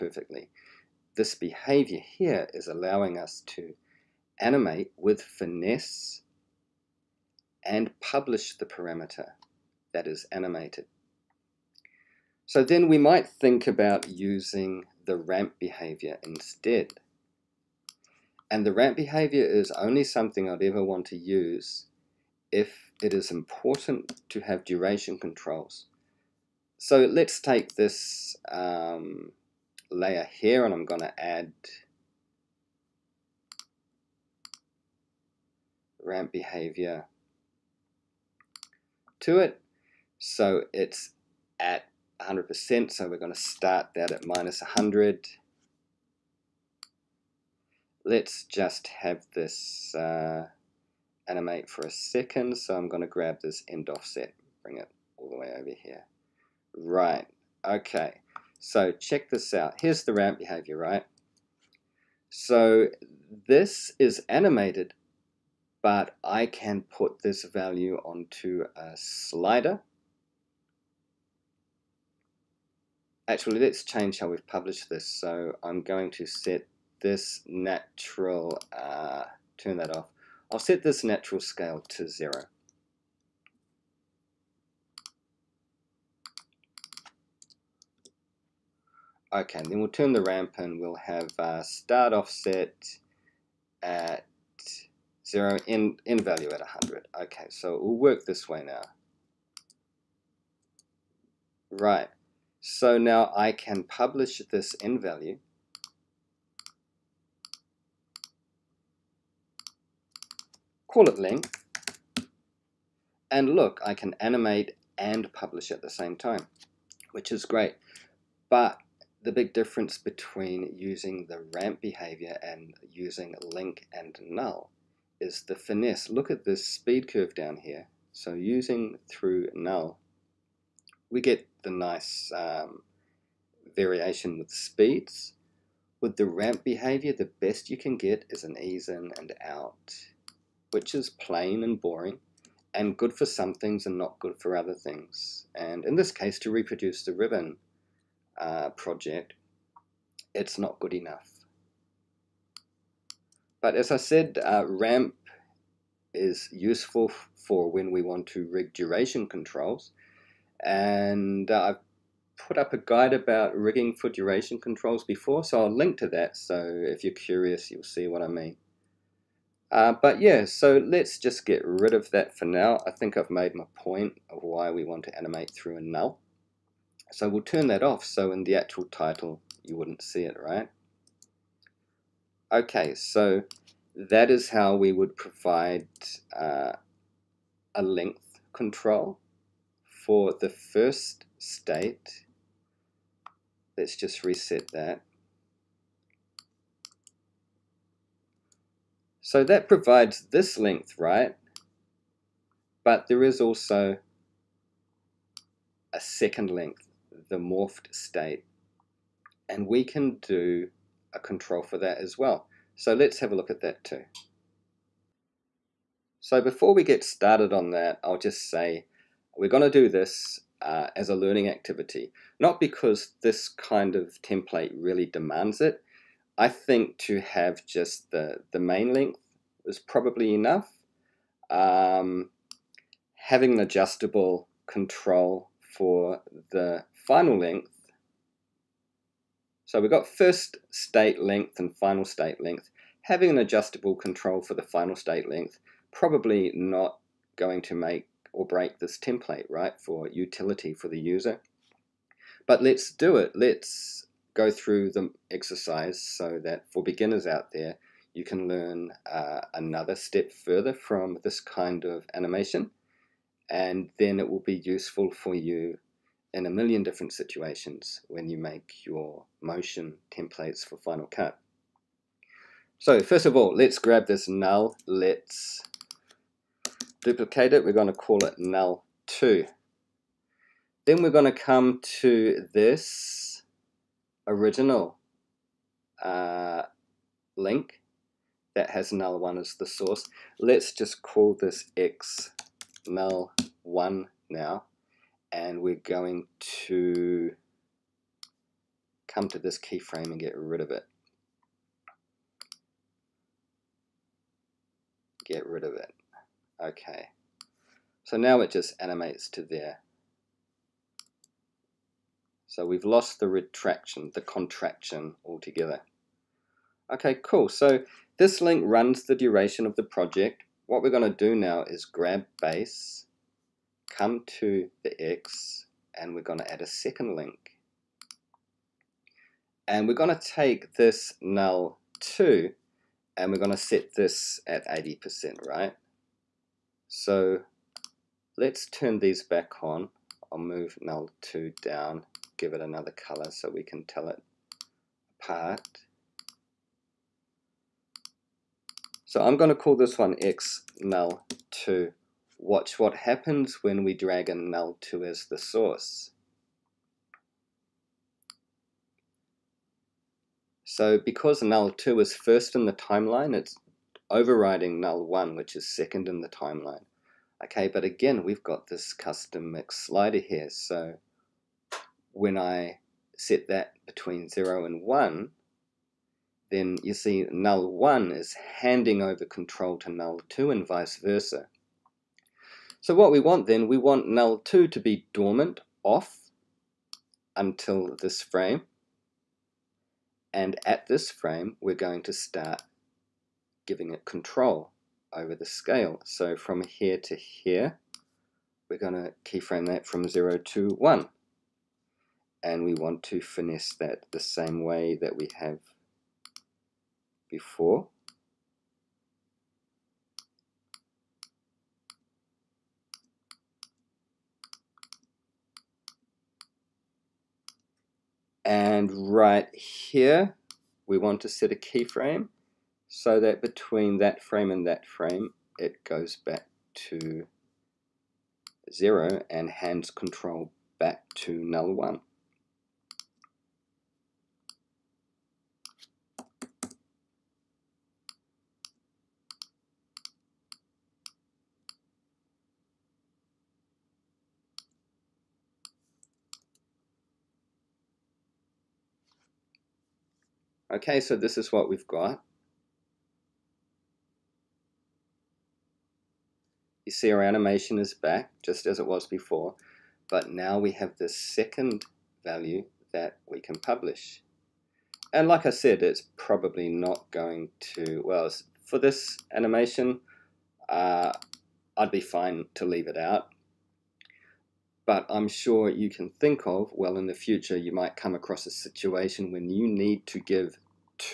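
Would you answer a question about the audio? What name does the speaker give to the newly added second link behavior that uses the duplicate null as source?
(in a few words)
x null 2.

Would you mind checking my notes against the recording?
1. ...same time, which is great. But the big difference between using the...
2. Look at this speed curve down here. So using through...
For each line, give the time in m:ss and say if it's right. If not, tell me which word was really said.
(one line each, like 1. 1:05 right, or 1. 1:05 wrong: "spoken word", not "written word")
1. 1:55 right
2. 2:06 right.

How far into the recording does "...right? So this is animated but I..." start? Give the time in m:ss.
1:00.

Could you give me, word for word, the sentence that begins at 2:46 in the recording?
So if you're curious, you'll see what I mean.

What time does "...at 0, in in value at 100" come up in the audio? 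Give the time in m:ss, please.
1:33.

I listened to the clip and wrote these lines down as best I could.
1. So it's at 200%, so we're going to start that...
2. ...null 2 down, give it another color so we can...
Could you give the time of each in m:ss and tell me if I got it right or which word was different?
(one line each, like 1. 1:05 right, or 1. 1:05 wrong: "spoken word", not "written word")
1. 0:40 wrong: "100", not "200"
2. 5:40 right.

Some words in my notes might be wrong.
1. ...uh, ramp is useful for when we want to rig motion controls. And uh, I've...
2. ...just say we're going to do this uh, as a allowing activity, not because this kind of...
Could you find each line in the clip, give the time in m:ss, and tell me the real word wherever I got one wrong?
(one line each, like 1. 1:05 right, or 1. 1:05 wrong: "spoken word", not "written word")
1. 2:34 wrong: "duration", not "motion"
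2. 3:38 wrong: "learning", not "allowing".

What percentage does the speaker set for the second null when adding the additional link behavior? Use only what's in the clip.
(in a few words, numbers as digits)
80%.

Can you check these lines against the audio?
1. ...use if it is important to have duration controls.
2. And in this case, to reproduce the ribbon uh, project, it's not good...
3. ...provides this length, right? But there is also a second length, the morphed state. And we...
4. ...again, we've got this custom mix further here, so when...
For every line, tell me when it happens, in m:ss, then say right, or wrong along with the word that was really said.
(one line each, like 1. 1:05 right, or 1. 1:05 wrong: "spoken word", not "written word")
1. 0:21 right
2. 2:25 right
3. 3:19 right
4. 6:07 wrong: "slider", not "further".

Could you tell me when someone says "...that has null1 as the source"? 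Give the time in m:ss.
4:48.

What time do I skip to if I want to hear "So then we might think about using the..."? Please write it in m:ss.
0:12.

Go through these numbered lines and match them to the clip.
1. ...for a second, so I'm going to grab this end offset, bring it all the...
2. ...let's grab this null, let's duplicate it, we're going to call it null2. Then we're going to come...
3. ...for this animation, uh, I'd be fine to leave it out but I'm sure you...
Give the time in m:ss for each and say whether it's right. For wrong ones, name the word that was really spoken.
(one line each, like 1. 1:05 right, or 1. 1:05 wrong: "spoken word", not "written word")
1. 0:51 right
2. 4:33 right
3. 7:48 right.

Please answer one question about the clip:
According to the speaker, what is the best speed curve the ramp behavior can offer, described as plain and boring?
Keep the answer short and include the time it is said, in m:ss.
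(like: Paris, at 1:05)
ease in and out, at 2:18.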